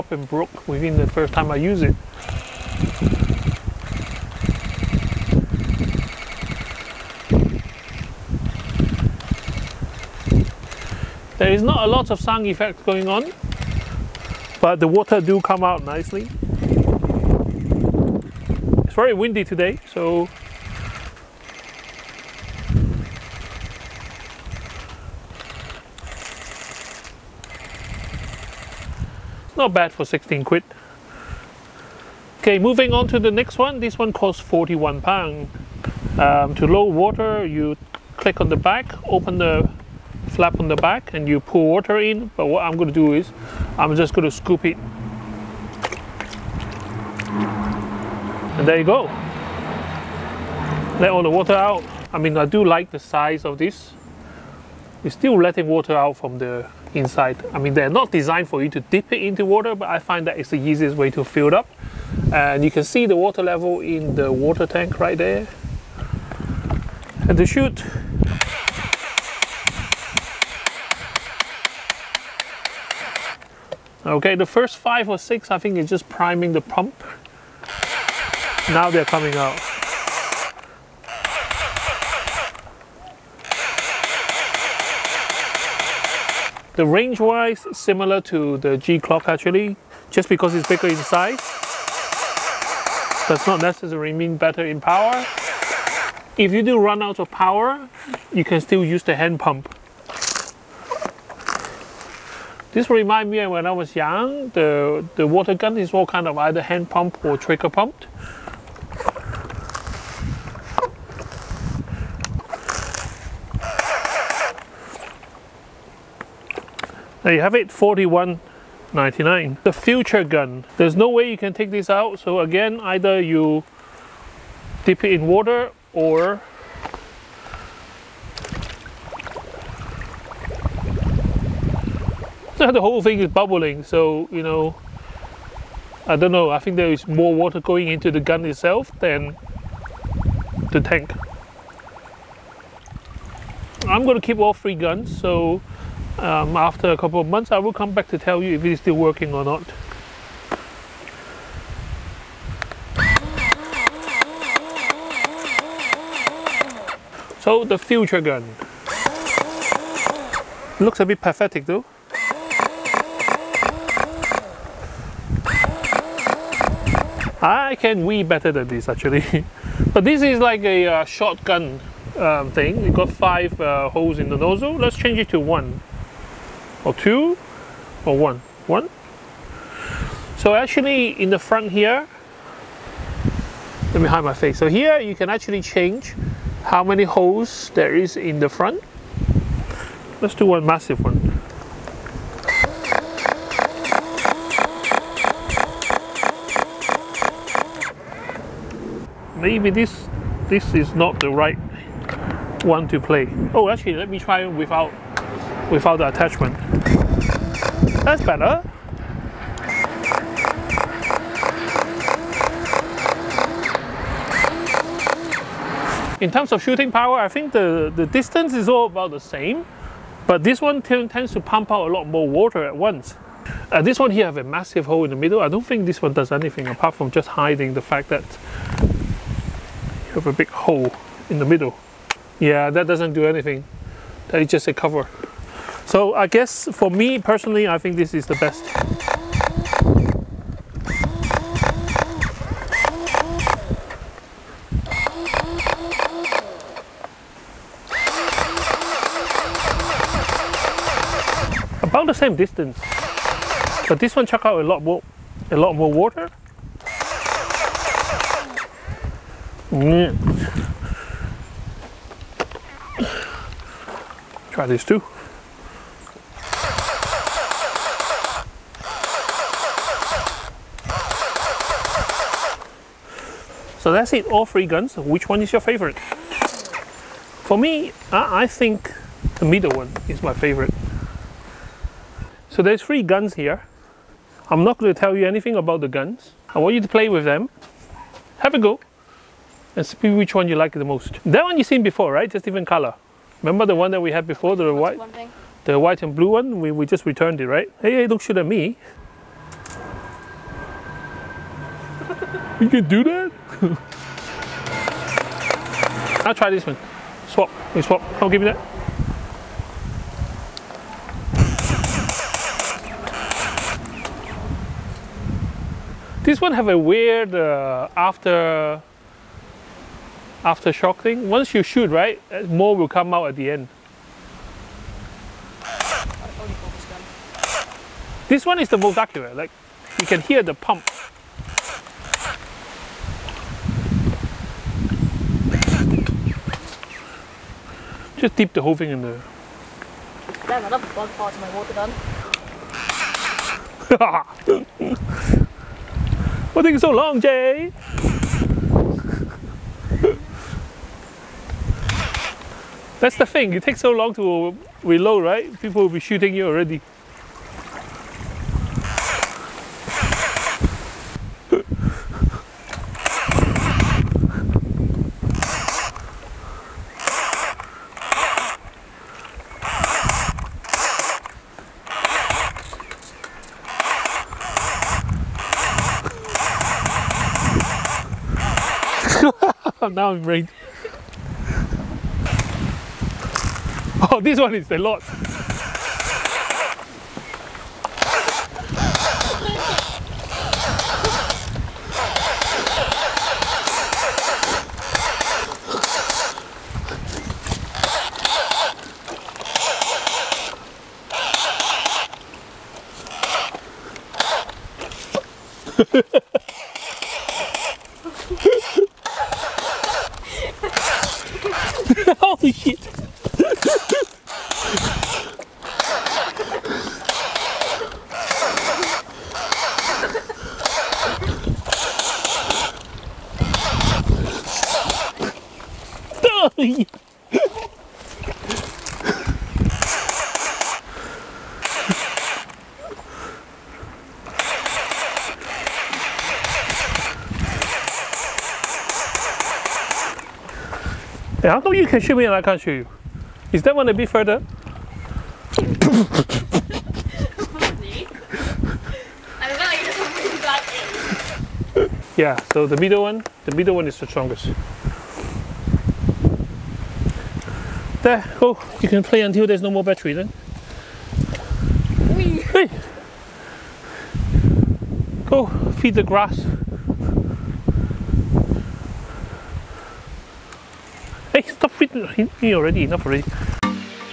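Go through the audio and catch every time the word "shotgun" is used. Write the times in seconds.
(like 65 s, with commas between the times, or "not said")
171 s.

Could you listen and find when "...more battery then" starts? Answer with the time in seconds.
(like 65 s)
459 s.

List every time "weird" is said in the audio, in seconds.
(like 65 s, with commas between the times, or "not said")
316 s.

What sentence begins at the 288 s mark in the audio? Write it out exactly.
Have a go and see which one you like the most.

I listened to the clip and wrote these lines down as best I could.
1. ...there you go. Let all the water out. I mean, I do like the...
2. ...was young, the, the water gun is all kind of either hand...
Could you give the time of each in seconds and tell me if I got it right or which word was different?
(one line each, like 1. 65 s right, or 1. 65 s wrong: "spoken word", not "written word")
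1. 48 s right
2. 103 s right.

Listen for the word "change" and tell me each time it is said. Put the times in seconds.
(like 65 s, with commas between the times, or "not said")
174 s, 185 s.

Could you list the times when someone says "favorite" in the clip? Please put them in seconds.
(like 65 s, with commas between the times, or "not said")
275 s, 280 s.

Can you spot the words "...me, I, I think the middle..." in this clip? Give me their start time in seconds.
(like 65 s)
277 s.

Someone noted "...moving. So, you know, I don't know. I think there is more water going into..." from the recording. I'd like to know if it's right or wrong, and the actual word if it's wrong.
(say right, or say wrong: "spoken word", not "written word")
wrong: "bubbling", not "moving".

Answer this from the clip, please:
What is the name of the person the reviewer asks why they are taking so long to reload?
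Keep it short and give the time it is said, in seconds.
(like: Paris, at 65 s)
Jay, at 347 s.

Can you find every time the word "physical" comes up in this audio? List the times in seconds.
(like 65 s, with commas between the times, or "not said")
not said.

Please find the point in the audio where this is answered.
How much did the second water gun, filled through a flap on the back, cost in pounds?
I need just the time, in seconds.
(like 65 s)
34 s.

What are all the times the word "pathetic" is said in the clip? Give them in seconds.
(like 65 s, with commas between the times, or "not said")
161 s.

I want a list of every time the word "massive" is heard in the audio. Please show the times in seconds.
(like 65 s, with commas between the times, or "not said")
190 s, 224 s.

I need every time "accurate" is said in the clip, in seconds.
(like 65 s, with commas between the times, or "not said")
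328 s.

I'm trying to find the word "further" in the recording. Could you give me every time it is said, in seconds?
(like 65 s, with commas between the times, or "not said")
444 s.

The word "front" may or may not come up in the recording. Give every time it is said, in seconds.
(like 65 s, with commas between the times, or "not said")
181 s, 188 s.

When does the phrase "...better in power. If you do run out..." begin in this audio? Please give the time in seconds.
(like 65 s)
94 s.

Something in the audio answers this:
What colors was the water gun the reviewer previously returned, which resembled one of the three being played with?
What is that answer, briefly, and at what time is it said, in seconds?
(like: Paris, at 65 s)
white and blue, at 295 s.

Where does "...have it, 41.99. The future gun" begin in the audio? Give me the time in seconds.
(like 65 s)
117 s.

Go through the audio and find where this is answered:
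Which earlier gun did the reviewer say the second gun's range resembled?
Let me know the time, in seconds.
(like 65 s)
88 s.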